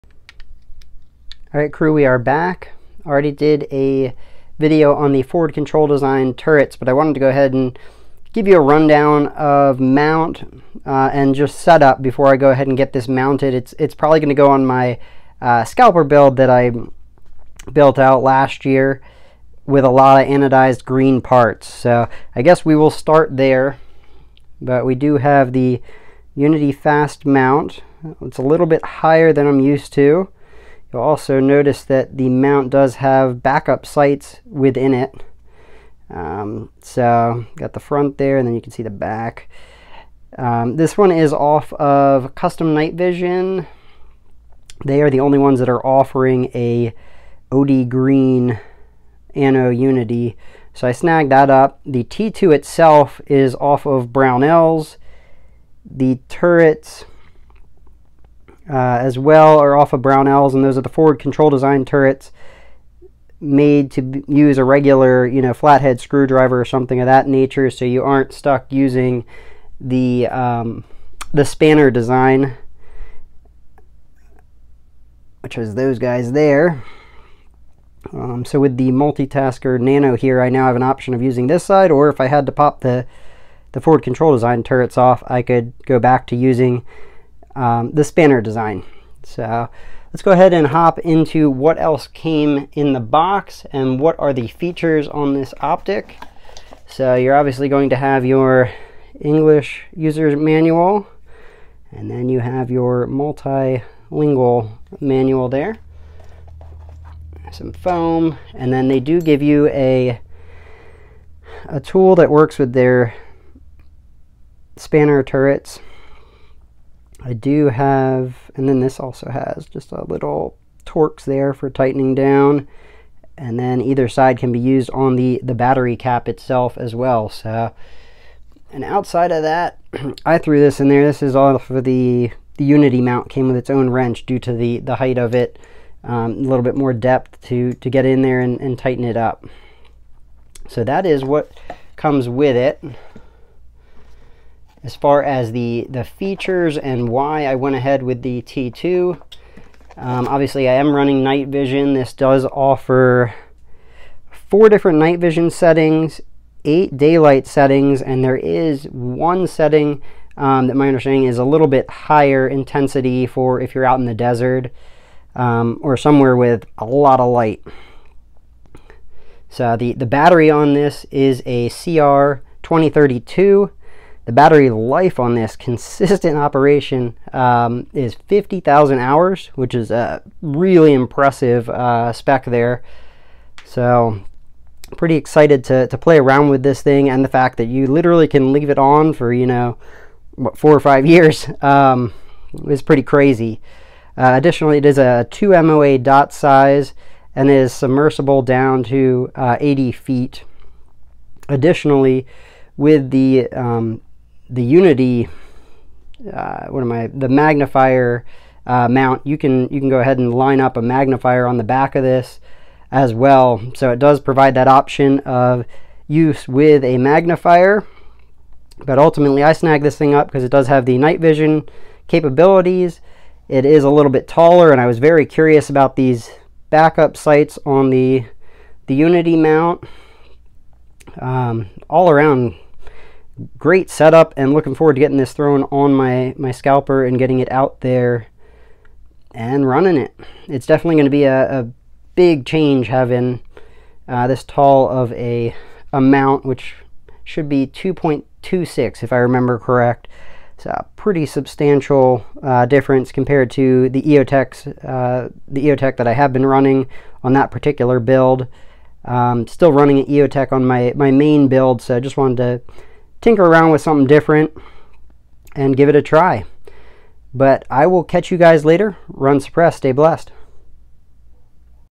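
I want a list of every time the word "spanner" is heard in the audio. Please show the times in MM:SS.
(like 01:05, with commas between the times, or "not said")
01:11, 01:28, 01:54.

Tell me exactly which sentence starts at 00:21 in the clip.
So I guess we will start there, but we do have the Unity fast mount.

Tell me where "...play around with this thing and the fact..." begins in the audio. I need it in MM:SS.
03:05.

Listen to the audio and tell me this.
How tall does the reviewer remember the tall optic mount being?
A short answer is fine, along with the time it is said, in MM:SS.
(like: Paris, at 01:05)
2.26, at 04:07.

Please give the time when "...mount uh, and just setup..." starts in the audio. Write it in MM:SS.
00:09.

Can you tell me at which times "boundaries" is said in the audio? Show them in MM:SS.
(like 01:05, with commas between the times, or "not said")
not said.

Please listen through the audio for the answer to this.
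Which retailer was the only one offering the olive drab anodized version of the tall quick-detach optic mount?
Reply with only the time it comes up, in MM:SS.
00:42.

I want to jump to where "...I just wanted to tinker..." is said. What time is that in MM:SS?
04:21.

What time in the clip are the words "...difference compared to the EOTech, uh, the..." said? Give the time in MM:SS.
04:12.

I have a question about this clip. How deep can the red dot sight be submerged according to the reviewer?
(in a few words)
80 feet.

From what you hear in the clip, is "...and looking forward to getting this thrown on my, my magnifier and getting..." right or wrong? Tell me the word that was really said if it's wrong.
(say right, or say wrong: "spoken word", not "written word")
wrong: "scalper", not "magnifier".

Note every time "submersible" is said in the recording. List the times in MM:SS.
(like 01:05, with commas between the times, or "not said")
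03:17.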